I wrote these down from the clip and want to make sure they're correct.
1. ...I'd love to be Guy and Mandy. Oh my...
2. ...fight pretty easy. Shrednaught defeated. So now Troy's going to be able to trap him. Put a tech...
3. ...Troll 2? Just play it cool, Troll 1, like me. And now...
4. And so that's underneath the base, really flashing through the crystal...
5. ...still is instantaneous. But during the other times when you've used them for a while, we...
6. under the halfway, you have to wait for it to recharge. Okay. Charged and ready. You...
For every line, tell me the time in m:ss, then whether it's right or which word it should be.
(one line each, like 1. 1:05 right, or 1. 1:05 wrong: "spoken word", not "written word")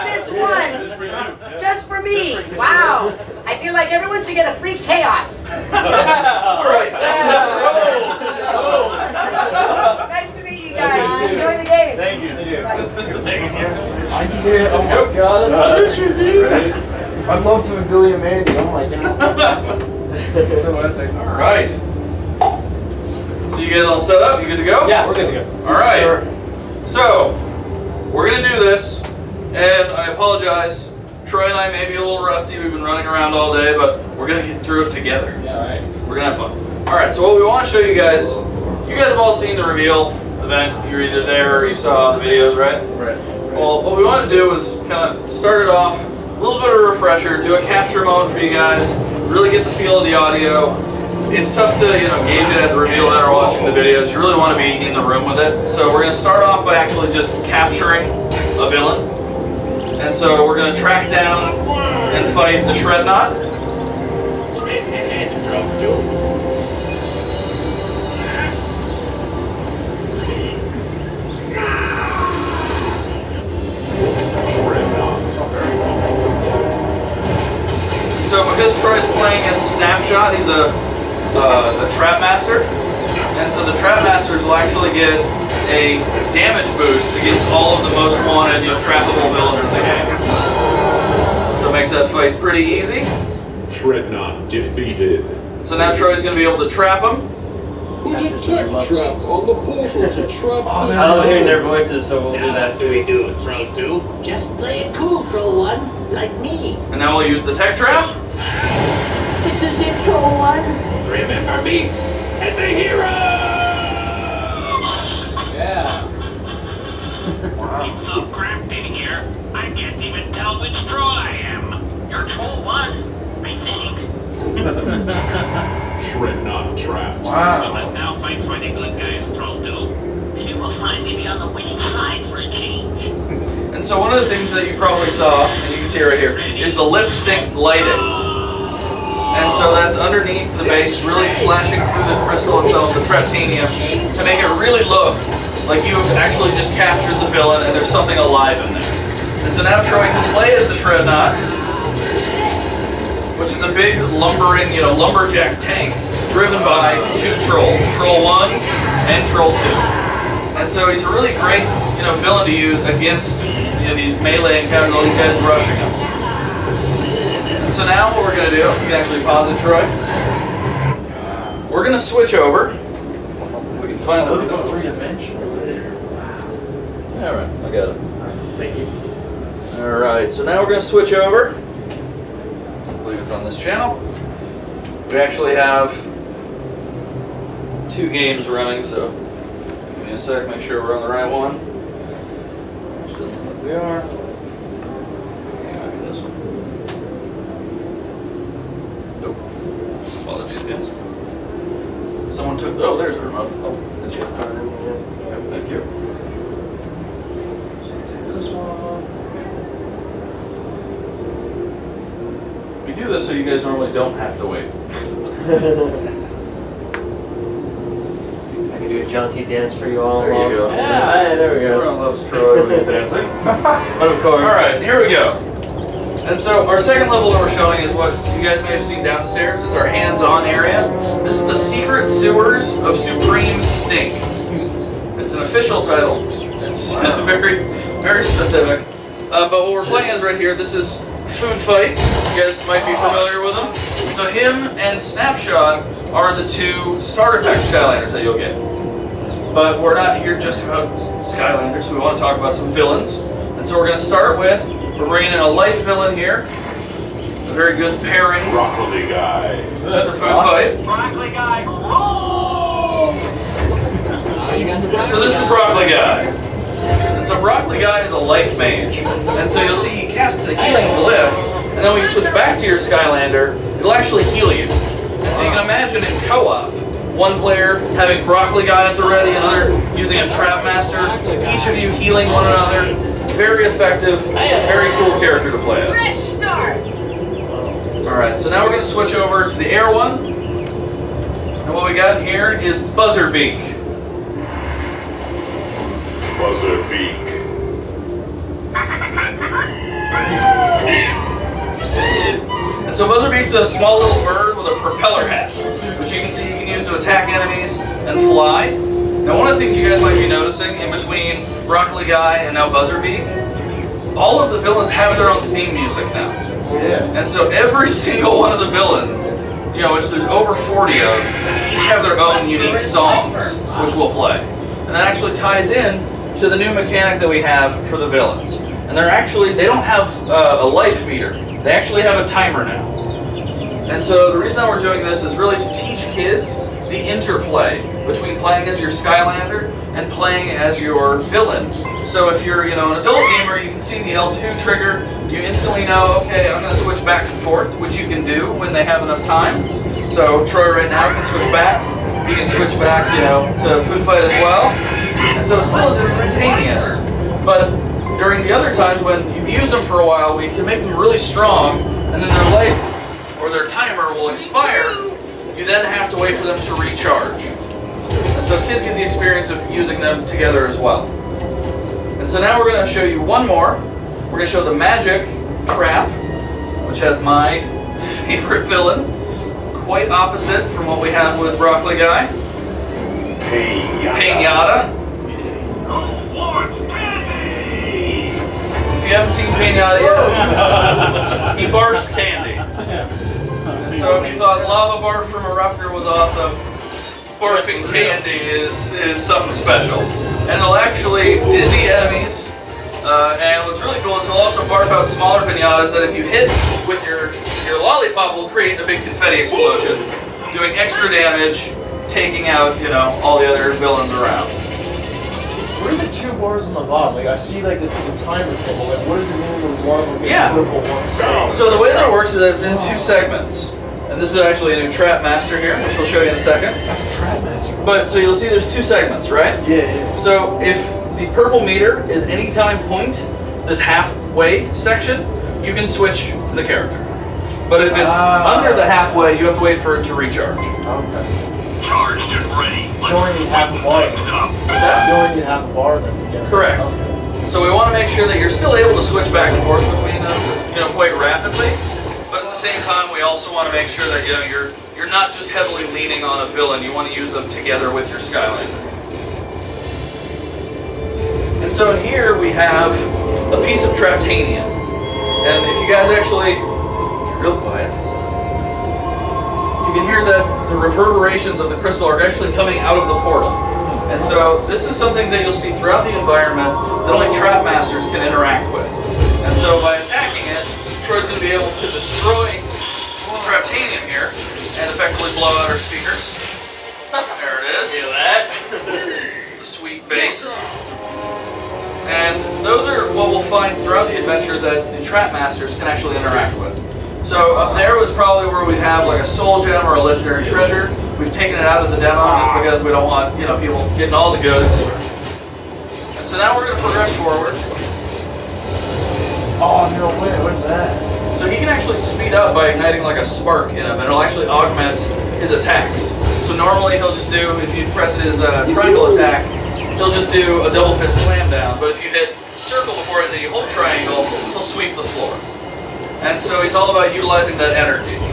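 1. 0:17 wrong: "Billy", not "Guy"
2. 1:32 right
3. 1:43 right
4. 2:19 right
5. 5:55 right
6. 7:18 right.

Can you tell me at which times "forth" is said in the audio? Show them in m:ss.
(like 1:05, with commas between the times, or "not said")
5:47, 7:29.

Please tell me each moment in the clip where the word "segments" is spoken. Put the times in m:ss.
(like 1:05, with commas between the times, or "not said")
7:02, 7:08.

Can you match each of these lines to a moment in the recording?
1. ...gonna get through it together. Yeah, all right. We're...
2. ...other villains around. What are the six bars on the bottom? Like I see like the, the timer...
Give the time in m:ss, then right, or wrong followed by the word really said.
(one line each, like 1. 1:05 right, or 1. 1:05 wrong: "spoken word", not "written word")
1. 0:34 right
2. 6:53 wrong: "two", not "six".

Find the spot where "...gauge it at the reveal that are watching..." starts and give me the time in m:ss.
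0:52.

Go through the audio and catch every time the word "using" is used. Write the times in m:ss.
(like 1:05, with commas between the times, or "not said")
4:39, 6:09.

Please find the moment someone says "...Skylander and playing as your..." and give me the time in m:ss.
5:38.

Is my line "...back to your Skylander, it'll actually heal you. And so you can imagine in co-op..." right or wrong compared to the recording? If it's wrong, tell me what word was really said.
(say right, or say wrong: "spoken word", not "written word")
right.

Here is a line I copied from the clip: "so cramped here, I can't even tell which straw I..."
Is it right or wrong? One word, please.
right.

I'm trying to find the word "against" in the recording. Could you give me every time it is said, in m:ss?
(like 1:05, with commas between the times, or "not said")
1:27, 2:42.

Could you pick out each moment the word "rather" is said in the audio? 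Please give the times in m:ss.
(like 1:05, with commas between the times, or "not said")
not said.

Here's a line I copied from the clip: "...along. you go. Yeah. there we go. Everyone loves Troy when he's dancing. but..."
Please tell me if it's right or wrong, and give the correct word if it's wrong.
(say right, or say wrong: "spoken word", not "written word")
right.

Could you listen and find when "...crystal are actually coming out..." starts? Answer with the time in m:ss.
7:51.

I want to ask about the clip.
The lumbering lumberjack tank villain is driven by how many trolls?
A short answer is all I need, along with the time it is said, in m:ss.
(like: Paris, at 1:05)
2, at 2:37.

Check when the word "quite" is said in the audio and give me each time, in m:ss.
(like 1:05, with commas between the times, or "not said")
6:19, 7:30.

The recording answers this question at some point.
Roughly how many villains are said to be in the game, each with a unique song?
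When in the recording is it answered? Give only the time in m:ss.
5:20.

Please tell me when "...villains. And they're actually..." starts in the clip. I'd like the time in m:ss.
5:28.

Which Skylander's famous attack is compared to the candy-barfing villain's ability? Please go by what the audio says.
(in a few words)
Eruptor.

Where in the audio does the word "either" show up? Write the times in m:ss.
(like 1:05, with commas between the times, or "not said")
0:41.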